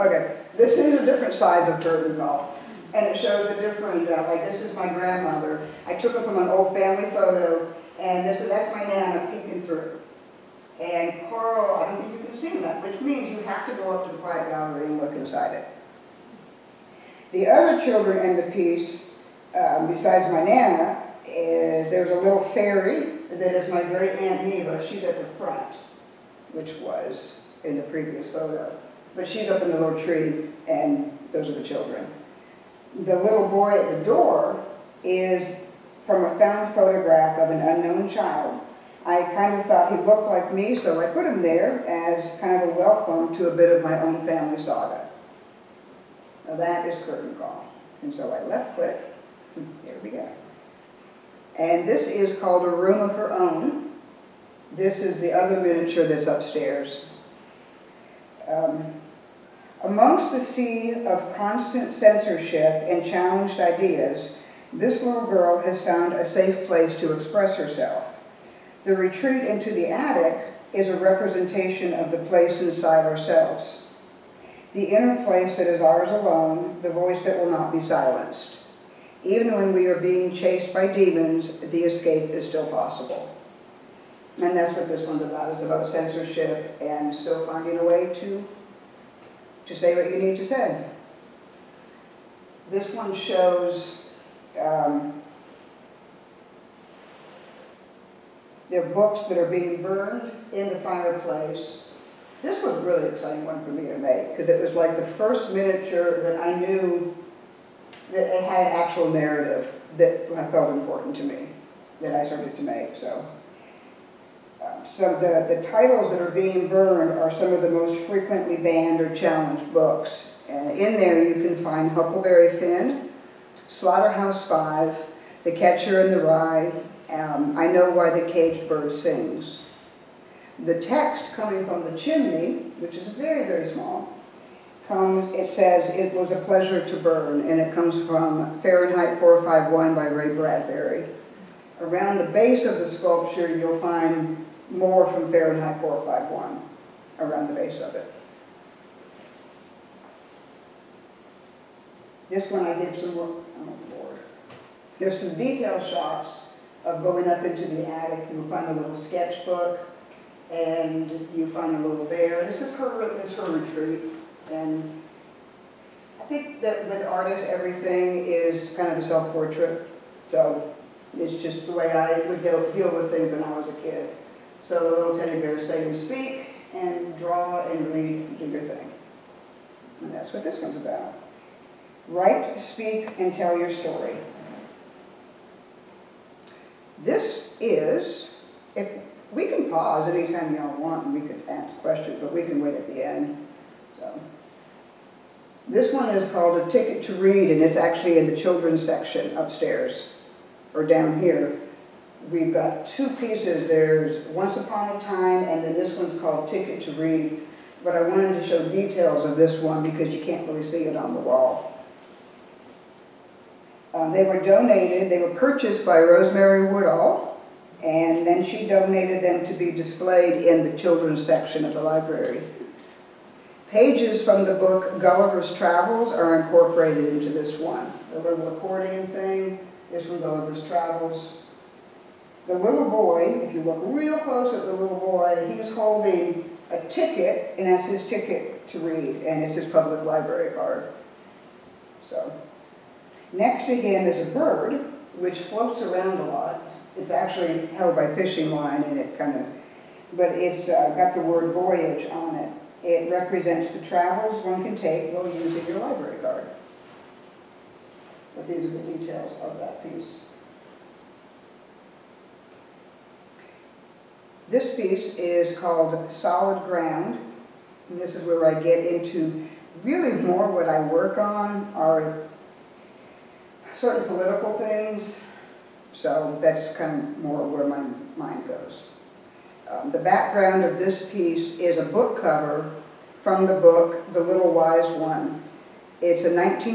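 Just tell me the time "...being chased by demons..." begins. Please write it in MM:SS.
01:19.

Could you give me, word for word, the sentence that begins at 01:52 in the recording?
So, um, so the, the titles that are being burned are some of the most frequently banned or challenged books.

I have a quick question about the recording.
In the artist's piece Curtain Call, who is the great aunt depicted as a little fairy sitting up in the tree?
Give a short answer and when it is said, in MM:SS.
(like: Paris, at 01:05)
Neva, at 00:24.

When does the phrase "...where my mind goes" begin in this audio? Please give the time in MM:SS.
04:37.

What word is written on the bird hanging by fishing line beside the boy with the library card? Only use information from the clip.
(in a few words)
voyage.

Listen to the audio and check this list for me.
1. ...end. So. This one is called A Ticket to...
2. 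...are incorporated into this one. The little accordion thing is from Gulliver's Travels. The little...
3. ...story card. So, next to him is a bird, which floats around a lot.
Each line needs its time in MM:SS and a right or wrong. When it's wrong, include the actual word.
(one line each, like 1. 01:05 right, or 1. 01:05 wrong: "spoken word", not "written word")
1. 03:13 right
2. 03:46 right
3. 04:00 wrong: "library", not "story".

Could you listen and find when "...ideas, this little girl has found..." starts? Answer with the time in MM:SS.
01:03.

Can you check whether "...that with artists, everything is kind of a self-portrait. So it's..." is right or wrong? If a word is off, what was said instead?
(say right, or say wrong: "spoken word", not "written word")
right.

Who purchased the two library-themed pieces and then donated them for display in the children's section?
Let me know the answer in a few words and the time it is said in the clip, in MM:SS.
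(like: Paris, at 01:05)
Rosemary Woodall, at 03:35.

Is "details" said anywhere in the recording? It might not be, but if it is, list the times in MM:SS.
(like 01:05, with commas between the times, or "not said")
02:35, 03:28, 04:18.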